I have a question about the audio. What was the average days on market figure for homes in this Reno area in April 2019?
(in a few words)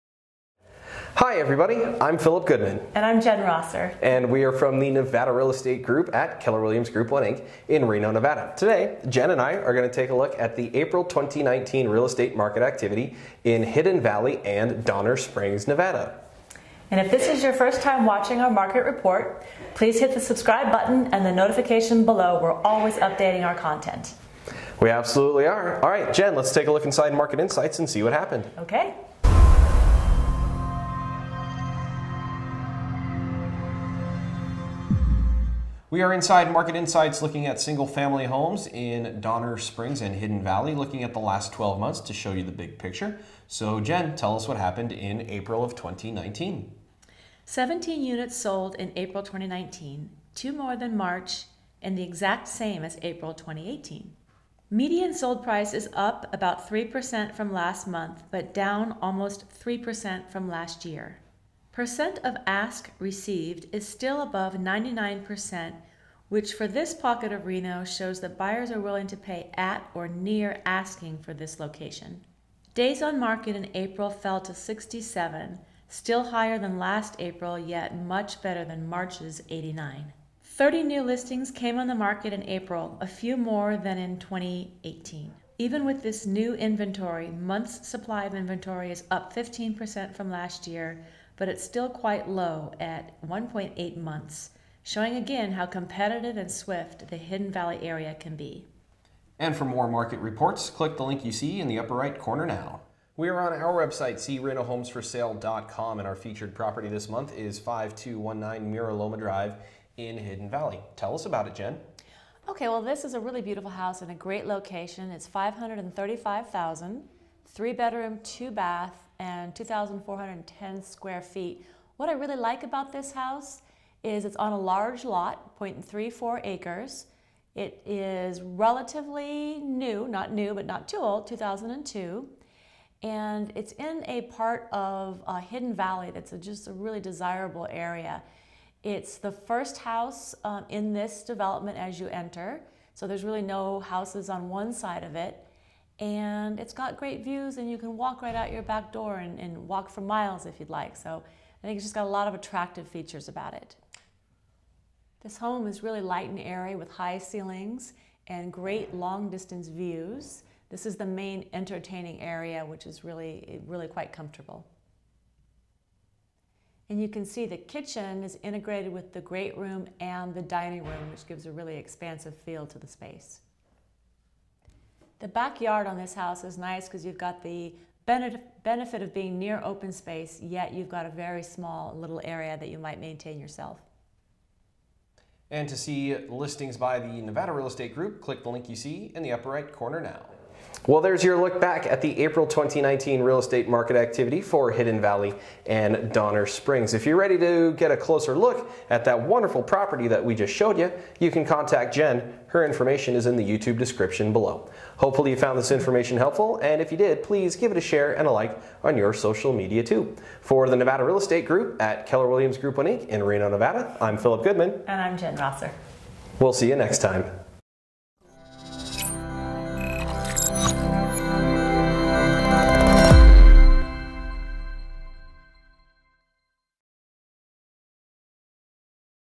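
67.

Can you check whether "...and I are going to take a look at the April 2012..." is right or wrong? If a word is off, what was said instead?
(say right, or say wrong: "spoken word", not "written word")
wrong: "2019", not "2012".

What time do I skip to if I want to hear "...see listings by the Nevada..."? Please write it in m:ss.
3:05.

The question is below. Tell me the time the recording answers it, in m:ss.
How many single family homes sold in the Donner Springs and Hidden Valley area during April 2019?
0:47.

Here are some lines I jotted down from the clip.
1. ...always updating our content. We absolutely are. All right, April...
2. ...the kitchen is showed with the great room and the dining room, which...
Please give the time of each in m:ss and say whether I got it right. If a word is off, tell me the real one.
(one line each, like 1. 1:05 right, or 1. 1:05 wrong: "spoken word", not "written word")
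1. 0:22 wrong: "Jen", not "April"
2. 2:47 wrong: "integrated", not "showed".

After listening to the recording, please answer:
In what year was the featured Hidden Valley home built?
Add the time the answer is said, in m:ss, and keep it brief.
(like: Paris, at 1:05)
2002, at 2:11.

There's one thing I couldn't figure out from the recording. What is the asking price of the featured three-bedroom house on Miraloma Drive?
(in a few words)
$535,000.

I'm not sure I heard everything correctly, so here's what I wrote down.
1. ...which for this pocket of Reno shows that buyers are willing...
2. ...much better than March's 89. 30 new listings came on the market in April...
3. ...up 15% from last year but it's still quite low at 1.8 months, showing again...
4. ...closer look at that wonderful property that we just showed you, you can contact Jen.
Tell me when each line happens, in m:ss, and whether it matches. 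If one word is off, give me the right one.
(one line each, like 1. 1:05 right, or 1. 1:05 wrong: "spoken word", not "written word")
1. 1:06 right
2. 1:17 right
3. 1:29 right
4. 3:17 right.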